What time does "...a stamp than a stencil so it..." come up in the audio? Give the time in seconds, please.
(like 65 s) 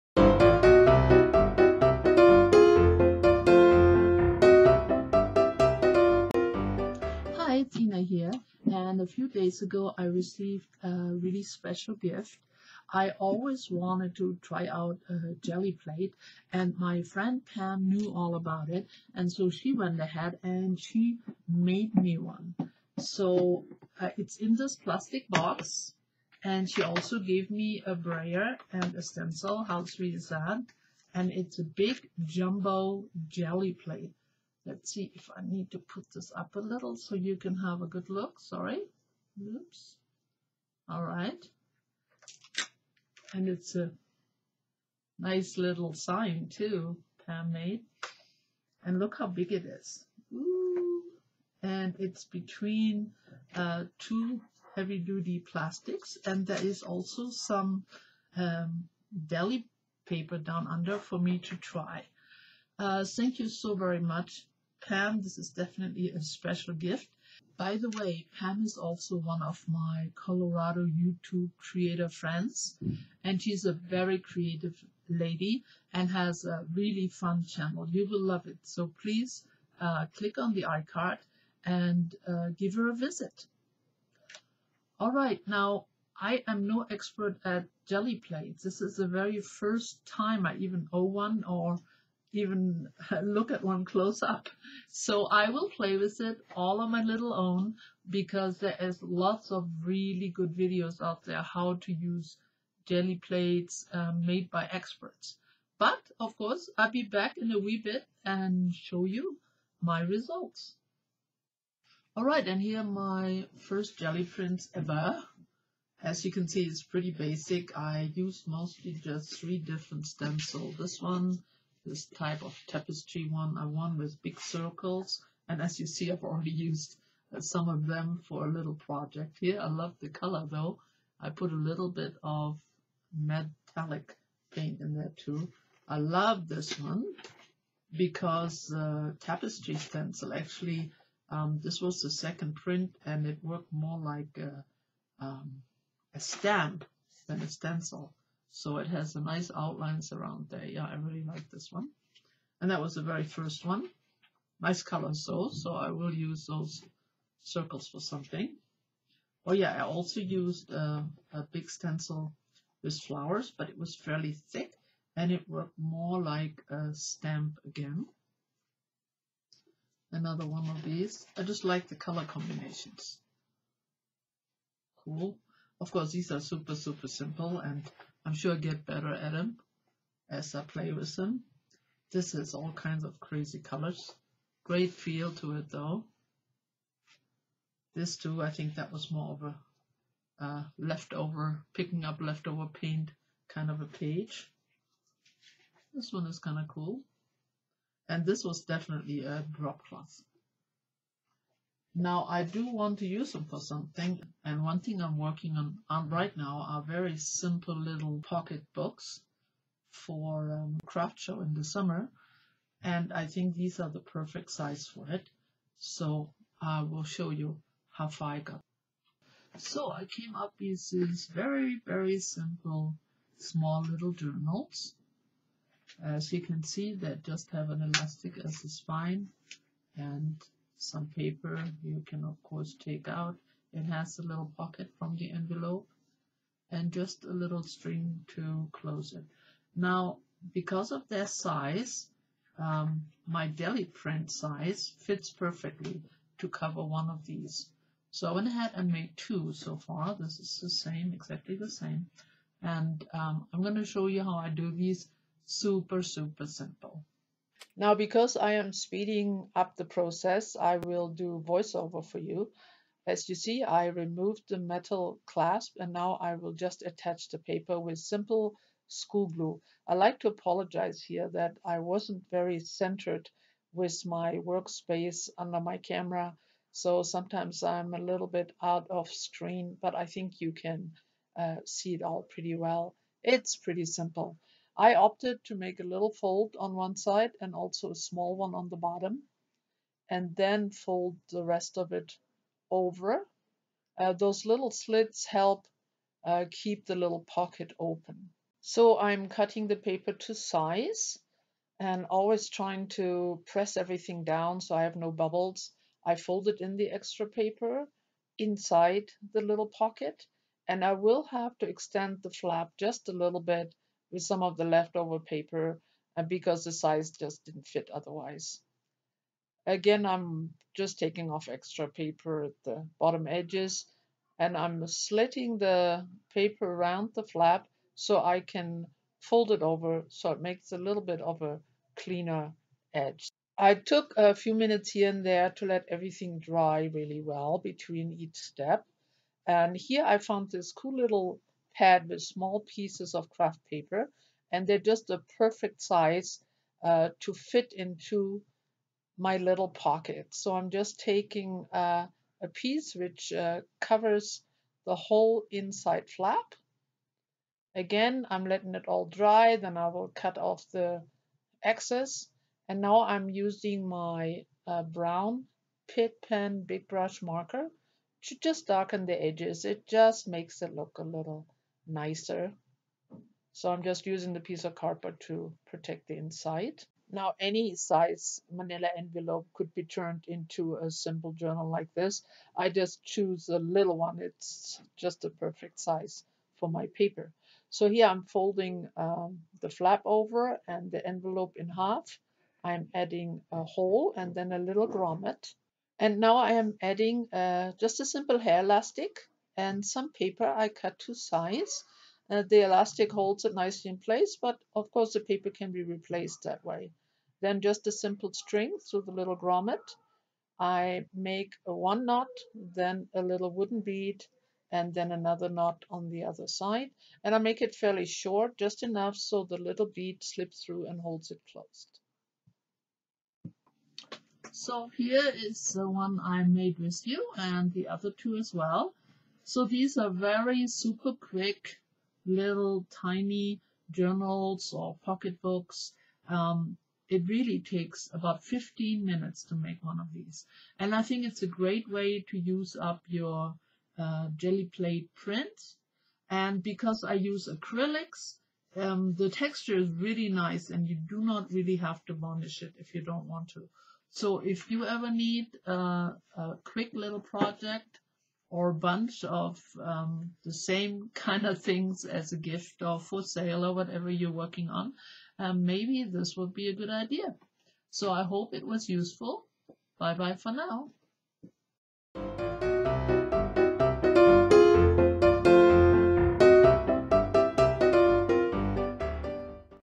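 146 s.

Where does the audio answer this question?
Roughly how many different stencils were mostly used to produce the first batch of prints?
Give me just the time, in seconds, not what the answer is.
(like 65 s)
119 s.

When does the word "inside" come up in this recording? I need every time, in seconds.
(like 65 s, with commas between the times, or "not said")
308 s, 355 s, 376 s.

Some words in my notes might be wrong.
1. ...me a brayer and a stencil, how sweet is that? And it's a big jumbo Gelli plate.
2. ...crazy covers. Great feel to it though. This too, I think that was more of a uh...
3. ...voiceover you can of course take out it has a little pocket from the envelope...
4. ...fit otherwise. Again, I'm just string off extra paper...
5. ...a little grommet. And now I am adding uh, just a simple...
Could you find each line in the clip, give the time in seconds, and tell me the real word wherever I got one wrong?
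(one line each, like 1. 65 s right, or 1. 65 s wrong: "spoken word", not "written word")
1. 27 s right
2. 183 s wrong: "colors", not "covers"
3. 231 s wrong: "paper", not "voiceover"
4. 317 s wrong: "taking", not "string"
5. 394 s right.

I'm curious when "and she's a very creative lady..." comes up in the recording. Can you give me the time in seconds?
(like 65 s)
73 s.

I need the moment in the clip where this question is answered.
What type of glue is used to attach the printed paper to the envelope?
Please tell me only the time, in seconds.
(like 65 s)
267 s.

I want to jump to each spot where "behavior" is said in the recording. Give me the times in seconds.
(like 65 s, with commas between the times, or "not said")
not said.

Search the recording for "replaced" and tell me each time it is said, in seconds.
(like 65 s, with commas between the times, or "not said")
405 s.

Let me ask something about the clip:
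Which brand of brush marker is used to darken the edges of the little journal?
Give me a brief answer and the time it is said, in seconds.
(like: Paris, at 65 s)
Pitt, at 365 s.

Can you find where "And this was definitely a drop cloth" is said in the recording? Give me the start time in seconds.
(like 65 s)
198 s.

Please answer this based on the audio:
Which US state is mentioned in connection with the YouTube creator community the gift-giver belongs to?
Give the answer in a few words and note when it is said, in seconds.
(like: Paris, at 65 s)
Colorado, at 70 s.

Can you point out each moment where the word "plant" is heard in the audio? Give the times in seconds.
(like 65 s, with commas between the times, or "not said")
not said.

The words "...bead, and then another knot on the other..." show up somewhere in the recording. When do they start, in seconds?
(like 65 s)
413 s.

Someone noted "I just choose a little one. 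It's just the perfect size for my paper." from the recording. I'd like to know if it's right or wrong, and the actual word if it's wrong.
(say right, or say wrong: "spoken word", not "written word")
right.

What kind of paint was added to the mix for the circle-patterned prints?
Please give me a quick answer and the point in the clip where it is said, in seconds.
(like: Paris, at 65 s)
metallic paint, at 133 s.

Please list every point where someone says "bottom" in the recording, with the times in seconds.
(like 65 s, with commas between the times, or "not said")
288 s, 322 s.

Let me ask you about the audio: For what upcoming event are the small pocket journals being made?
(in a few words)
craft show.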